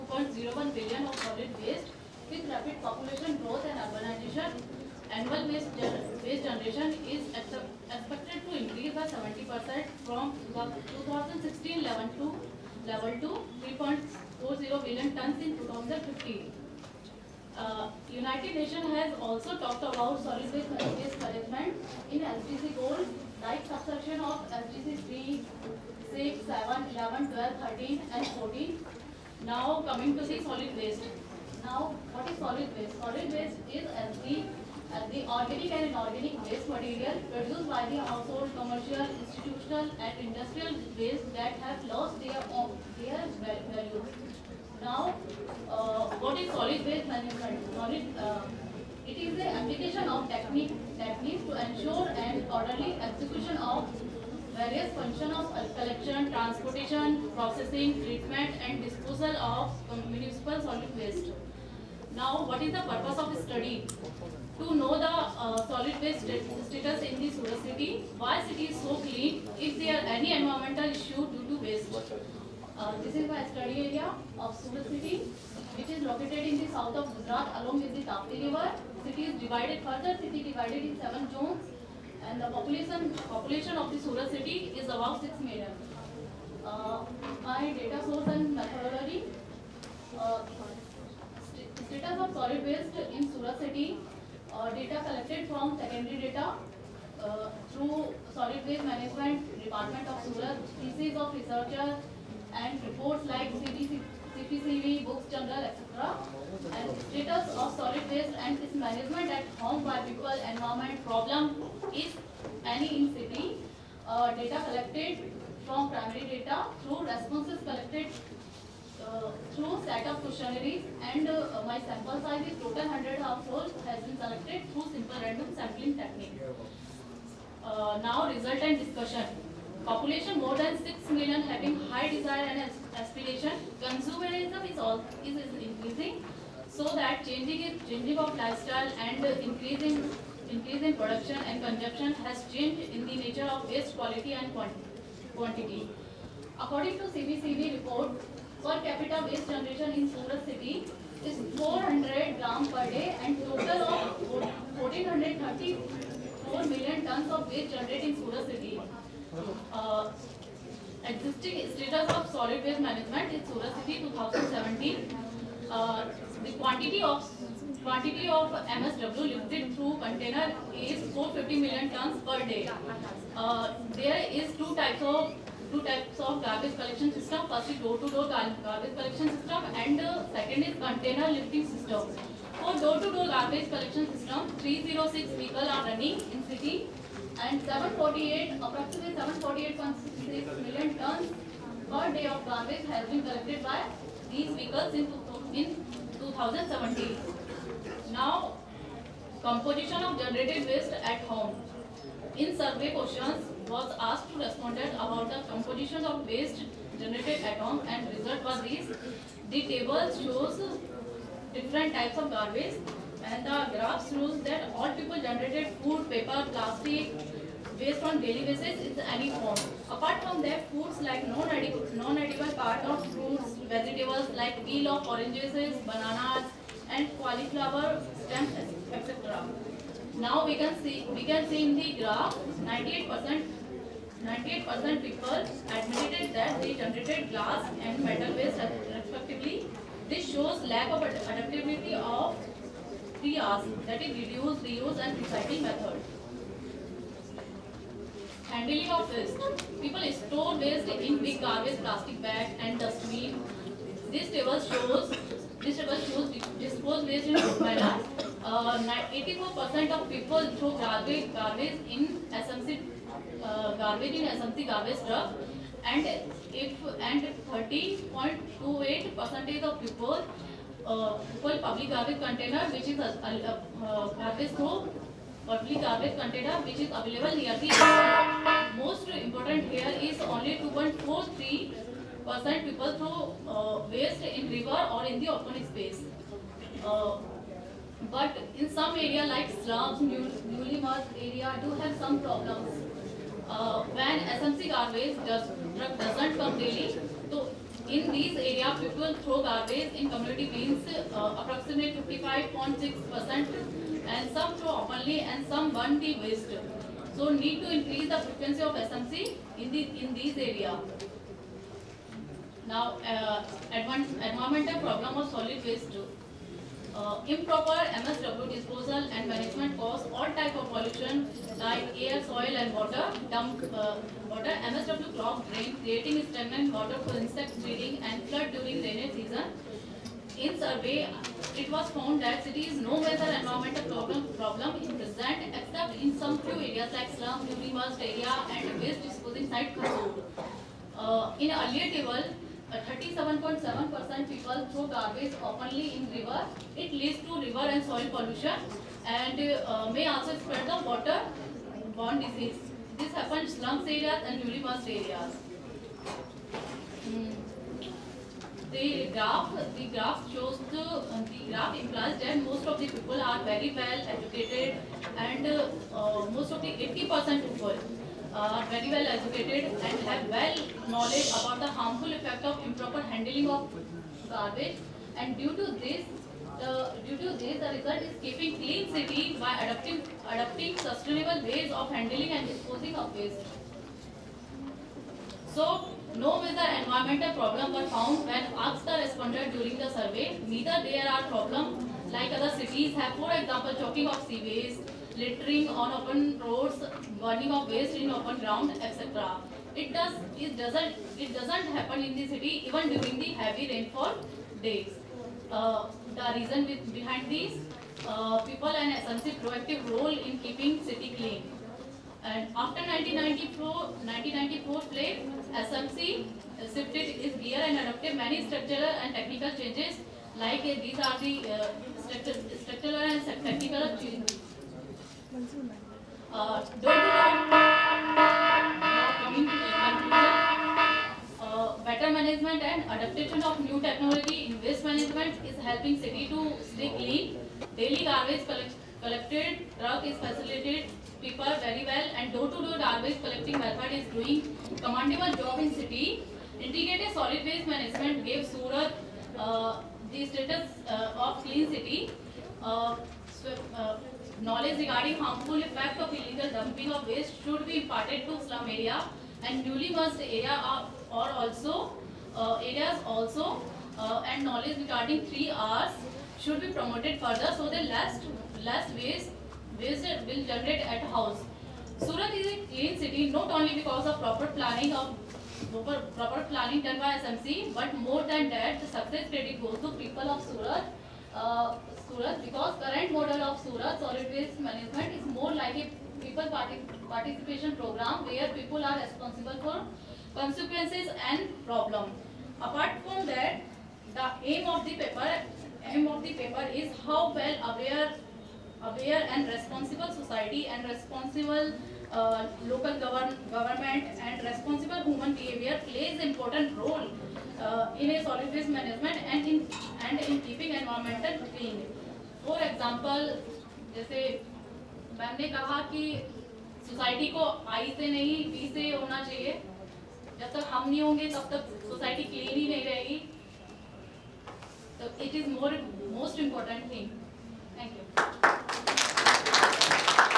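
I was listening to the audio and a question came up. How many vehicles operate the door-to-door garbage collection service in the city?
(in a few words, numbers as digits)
306.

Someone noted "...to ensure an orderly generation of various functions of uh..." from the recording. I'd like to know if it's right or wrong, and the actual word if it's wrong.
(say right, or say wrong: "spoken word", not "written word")
wrong: "execution", not "generation".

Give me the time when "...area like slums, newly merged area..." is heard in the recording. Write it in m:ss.
4:48.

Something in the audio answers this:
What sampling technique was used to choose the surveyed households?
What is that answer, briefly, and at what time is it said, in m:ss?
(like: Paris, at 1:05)
simple random sampling, at 2:04.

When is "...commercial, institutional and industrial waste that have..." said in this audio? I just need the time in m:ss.
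0:38.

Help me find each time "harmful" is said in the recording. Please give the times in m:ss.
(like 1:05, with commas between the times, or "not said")
6:11, 7:35.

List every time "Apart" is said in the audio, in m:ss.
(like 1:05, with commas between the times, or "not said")
3:39, 8:12.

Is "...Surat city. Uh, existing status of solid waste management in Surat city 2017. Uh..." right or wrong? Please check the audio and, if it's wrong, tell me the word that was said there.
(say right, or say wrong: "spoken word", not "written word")
right.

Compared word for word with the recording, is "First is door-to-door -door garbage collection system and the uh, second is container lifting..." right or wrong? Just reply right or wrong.
right.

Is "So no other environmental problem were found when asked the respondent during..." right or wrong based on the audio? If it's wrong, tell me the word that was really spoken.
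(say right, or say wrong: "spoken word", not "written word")
right.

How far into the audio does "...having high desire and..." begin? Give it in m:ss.
2:11.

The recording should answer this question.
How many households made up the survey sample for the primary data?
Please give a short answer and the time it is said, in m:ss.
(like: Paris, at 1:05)
100, at 2:02.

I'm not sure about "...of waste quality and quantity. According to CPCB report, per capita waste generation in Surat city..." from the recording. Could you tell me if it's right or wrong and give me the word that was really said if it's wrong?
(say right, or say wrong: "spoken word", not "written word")
right.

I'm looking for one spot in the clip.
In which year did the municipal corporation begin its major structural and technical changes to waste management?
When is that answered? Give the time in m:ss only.
6:54.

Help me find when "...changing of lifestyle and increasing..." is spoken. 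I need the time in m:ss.
2:17.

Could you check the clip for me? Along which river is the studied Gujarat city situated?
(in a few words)
Tapti.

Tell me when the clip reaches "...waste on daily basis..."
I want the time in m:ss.
3:37.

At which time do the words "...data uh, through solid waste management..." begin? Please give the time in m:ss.
1:36.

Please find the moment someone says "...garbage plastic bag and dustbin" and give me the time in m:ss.
4:11.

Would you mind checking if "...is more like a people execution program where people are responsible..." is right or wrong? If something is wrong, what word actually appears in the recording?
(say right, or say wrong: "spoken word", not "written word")
wrong: "participation", not "execution".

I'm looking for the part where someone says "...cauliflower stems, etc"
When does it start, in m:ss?
3:47.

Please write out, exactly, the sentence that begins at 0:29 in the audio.
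Now coming to the solid waste.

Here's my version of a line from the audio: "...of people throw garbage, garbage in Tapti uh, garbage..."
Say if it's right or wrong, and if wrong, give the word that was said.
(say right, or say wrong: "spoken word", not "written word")
wrong: "SMC", not "Tapti".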